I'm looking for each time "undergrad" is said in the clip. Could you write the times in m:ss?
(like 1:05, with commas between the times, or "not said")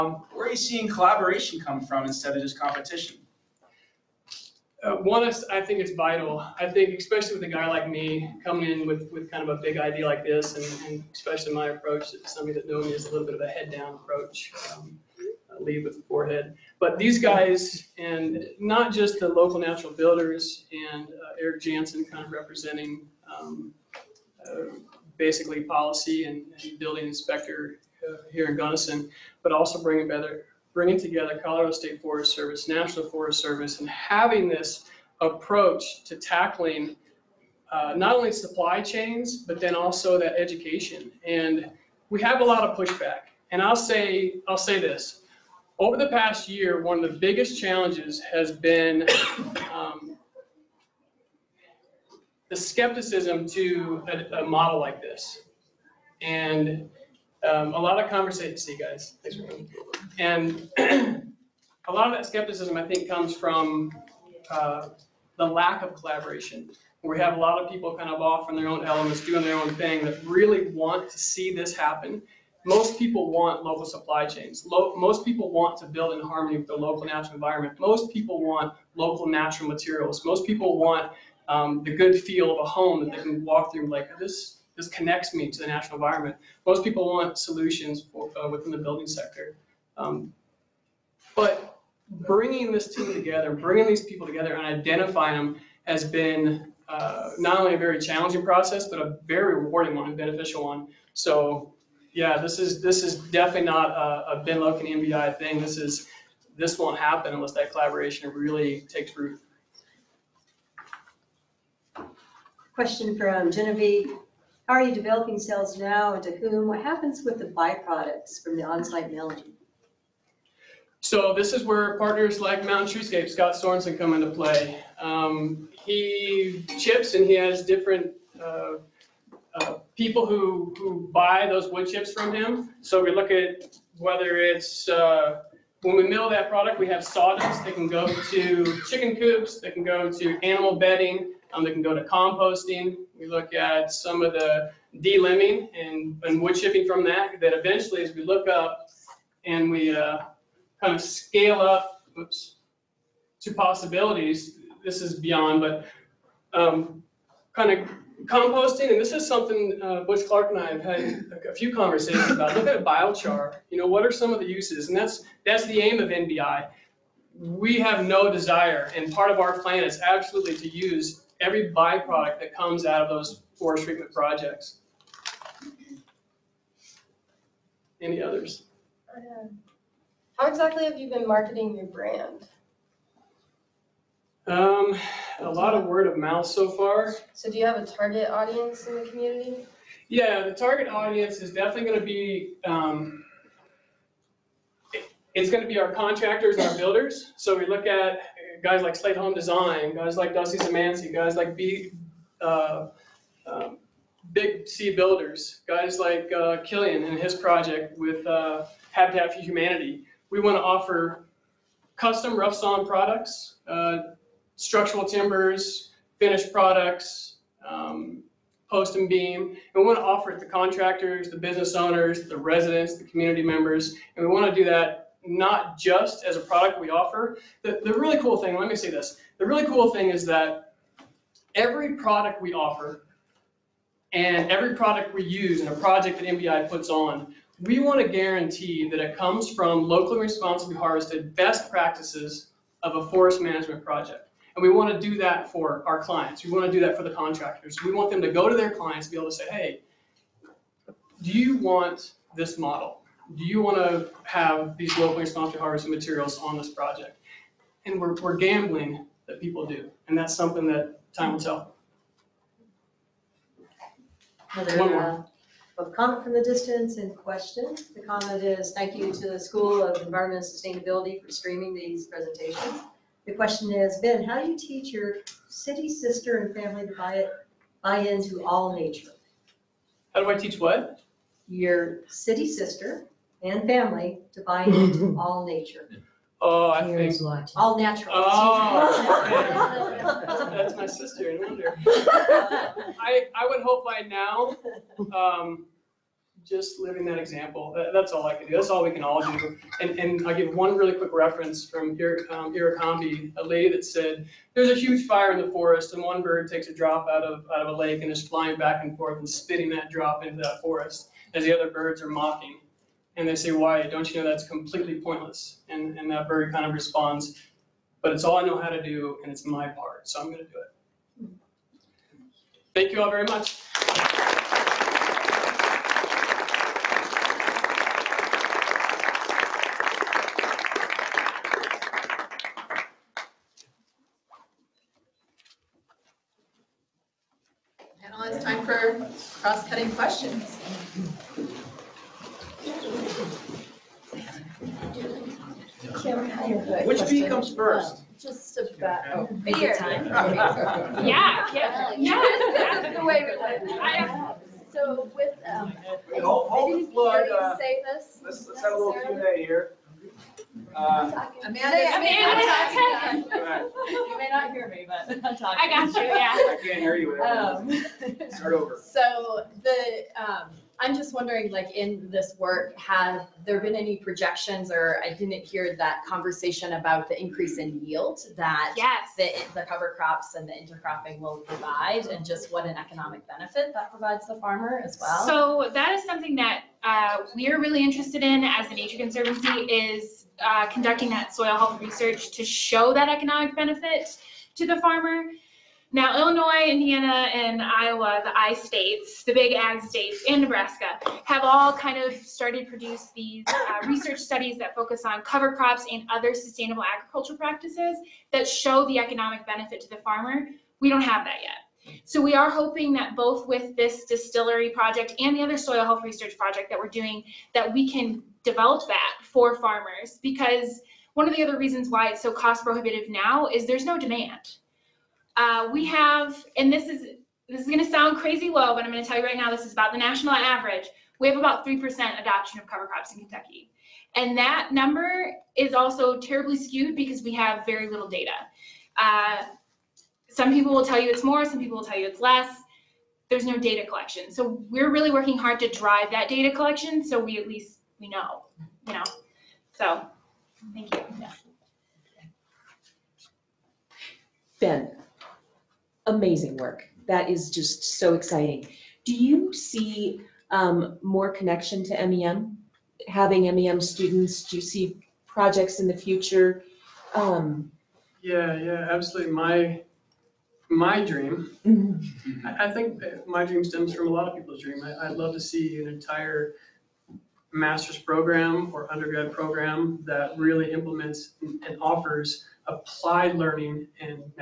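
7:58.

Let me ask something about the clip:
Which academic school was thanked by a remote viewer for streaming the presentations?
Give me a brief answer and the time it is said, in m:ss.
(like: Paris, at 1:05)
School of Environment and Sustainability, at 4:29.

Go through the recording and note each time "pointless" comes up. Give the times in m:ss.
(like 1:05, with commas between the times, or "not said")
5:15.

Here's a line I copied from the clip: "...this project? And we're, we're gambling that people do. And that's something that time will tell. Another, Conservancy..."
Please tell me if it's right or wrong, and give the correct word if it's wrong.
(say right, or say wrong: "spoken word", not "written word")
wrong: "One", not "Conservancy".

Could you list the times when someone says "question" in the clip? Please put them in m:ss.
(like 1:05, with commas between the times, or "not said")
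1:52, 4:27, 4:33, 5:39.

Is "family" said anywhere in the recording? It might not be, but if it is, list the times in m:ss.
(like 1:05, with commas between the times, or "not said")
4:36, 4:43.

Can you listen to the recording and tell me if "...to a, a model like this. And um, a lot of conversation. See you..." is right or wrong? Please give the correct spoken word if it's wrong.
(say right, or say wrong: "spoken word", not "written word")
right.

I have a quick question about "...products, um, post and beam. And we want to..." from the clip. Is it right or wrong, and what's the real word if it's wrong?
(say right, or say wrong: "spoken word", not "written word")
right.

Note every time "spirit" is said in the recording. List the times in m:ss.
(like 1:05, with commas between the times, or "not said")
not said.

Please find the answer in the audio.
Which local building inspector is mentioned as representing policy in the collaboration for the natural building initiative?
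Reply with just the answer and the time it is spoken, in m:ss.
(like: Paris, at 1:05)
Eric Jansen, at 0:21.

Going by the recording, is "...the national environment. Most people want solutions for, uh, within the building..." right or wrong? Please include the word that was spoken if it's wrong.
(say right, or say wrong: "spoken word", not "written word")
right.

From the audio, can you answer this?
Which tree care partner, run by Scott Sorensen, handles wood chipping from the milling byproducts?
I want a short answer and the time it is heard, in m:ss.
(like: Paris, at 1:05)
Mountain Treescape, at 2:02.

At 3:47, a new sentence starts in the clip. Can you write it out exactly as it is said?
The, the really cool thing, let me say this.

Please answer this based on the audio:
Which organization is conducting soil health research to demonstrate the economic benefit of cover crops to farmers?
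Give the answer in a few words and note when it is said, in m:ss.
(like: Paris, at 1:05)
The Nature Conservancy, at 6:28.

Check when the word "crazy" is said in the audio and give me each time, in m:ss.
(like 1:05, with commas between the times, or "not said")
7:08.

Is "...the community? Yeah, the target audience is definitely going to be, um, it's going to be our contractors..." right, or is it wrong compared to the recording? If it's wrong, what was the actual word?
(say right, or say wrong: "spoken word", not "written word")
right.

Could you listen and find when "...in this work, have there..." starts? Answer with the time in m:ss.
6:11.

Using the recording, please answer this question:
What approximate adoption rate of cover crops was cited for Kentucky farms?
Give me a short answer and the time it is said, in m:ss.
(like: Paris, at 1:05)
3%, at 7:11.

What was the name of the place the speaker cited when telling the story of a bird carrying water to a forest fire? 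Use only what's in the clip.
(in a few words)
Iracambi.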